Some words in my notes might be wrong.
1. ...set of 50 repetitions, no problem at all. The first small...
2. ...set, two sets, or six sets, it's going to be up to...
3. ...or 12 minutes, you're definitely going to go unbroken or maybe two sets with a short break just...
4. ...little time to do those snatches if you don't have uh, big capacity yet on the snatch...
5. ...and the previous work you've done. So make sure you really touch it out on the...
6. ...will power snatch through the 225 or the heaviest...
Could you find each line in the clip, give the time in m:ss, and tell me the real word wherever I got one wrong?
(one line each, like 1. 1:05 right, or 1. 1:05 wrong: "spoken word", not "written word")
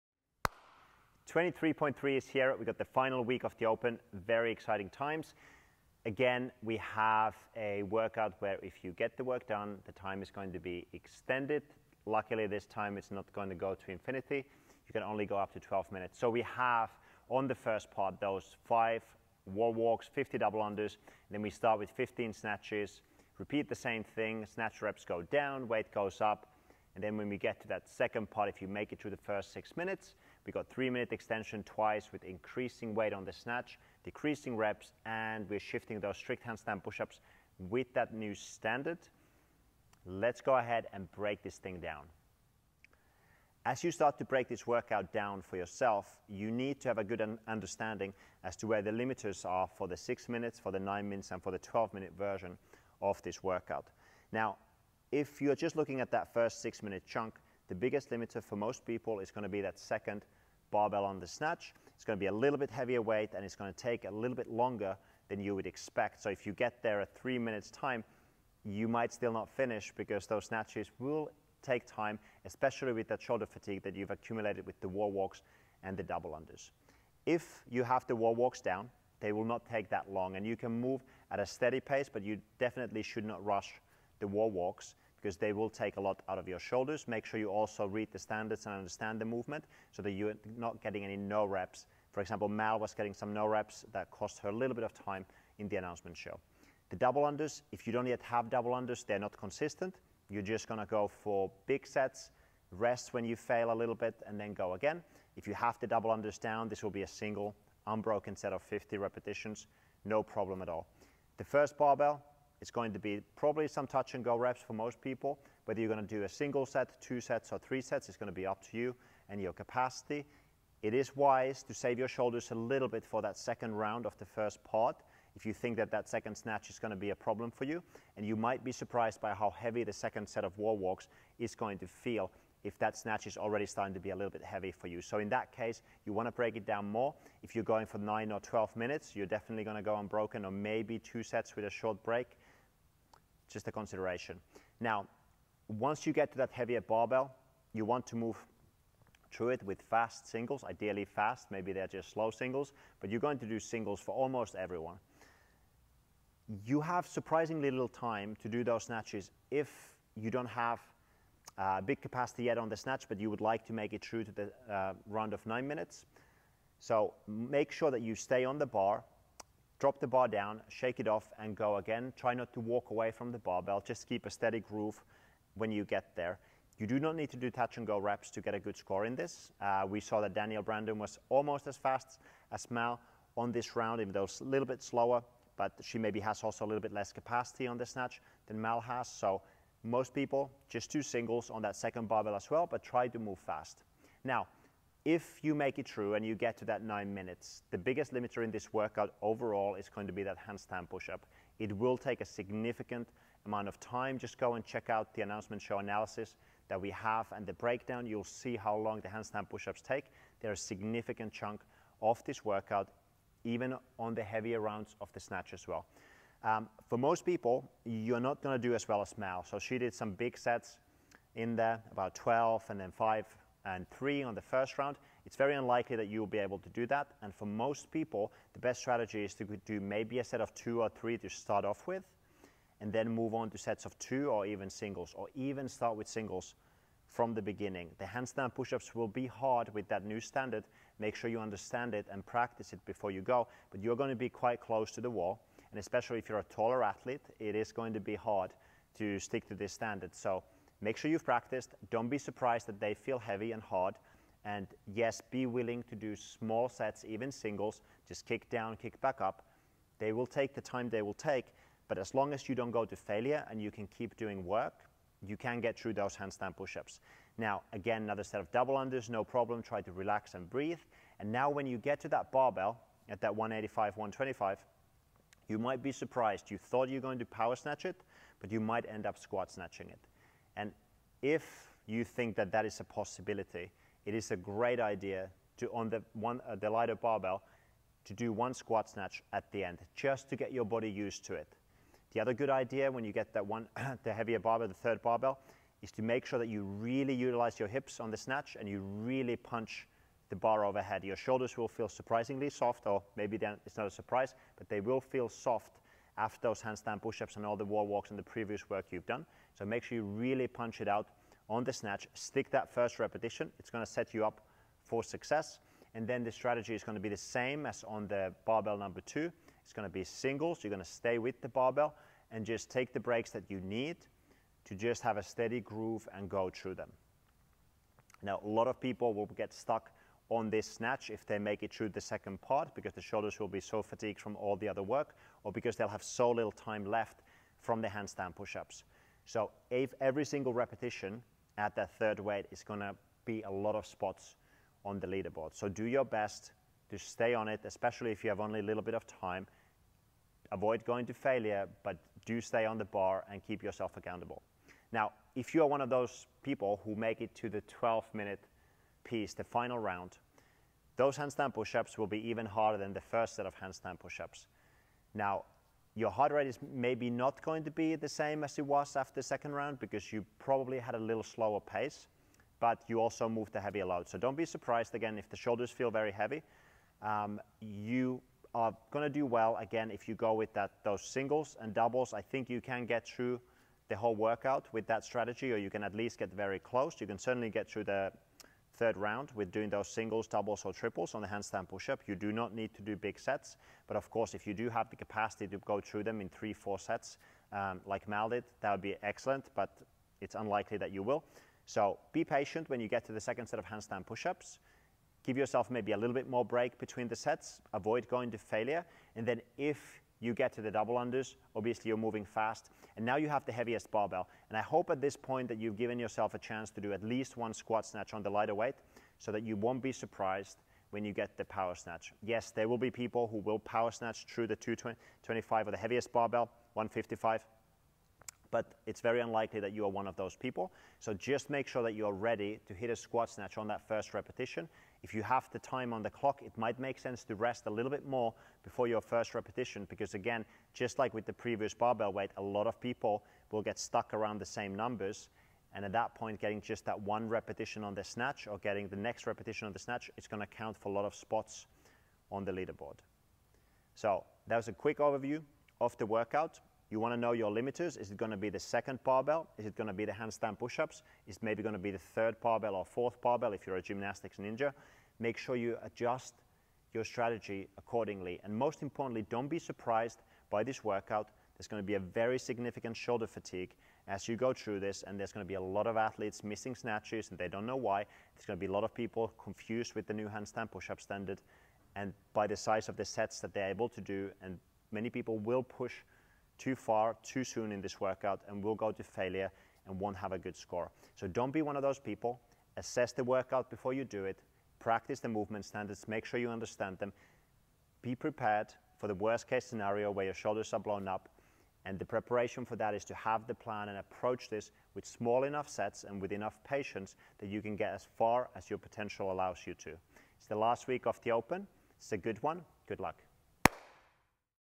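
1. 1:48 wrong: "barbell", not "small"
2. 1:56 wrong: "three", not "six"
3. 2:18 right
4. 2:37 right
5. 5:08 wrong: "punch", not "touch"
6. 7:03 right.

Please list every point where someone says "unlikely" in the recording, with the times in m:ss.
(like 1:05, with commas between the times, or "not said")
3:45, 6:40, 7:09.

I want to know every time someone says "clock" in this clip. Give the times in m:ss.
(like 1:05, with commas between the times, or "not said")
7:16.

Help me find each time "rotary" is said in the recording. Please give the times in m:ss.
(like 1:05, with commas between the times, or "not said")
not said.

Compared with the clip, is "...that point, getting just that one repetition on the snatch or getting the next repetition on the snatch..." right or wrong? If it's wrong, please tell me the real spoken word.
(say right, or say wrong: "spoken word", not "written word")
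right.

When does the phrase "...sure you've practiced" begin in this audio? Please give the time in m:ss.
4:10.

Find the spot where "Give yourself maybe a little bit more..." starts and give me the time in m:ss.
6:45.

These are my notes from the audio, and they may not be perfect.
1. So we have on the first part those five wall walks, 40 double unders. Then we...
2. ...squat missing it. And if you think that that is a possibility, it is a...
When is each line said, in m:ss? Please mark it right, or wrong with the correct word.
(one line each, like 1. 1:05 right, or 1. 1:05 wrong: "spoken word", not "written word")
1. 0:16 wrong: "50", not "40"
2. 4:39 wrong: "snatching", not "missing".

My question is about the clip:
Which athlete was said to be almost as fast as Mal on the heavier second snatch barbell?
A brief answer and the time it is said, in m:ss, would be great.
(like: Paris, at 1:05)
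Danielle Brandon, at 3:00.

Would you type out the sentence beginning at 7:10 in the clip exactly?
So just make sure that you are ready to hit a squat snatch on that first repetition.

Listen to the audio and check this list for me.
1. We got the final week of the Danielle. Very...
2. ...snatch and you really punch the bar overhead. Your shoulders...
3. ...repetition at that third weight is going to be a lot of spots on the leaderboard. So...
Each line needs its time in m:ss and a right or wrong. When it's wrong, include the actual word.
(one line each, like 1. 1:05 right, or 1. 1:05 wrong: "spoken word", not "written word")
1. 0:02 wrong: "Open", not "Danielle"
2. 4:58 right
3. 5:40 right.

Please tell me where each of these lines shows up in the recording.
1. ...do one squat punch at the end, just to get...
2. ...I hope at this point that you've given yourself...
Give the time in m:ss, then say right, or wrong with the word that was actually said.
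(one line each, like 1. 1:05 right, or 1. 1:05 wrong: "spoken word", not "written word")
1. 4:48 wrong: "snatch", not "punch"
2. 6:54 right.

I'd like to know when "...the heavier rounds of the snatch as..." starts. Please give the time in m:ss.
3:34.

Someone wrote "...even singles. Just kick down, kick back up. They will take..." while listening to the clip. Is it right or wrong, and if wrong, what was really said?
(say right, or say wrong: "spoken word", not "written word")
right.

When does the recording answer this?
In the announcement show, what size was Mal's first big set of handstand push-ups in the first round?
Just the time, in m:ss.
3:41.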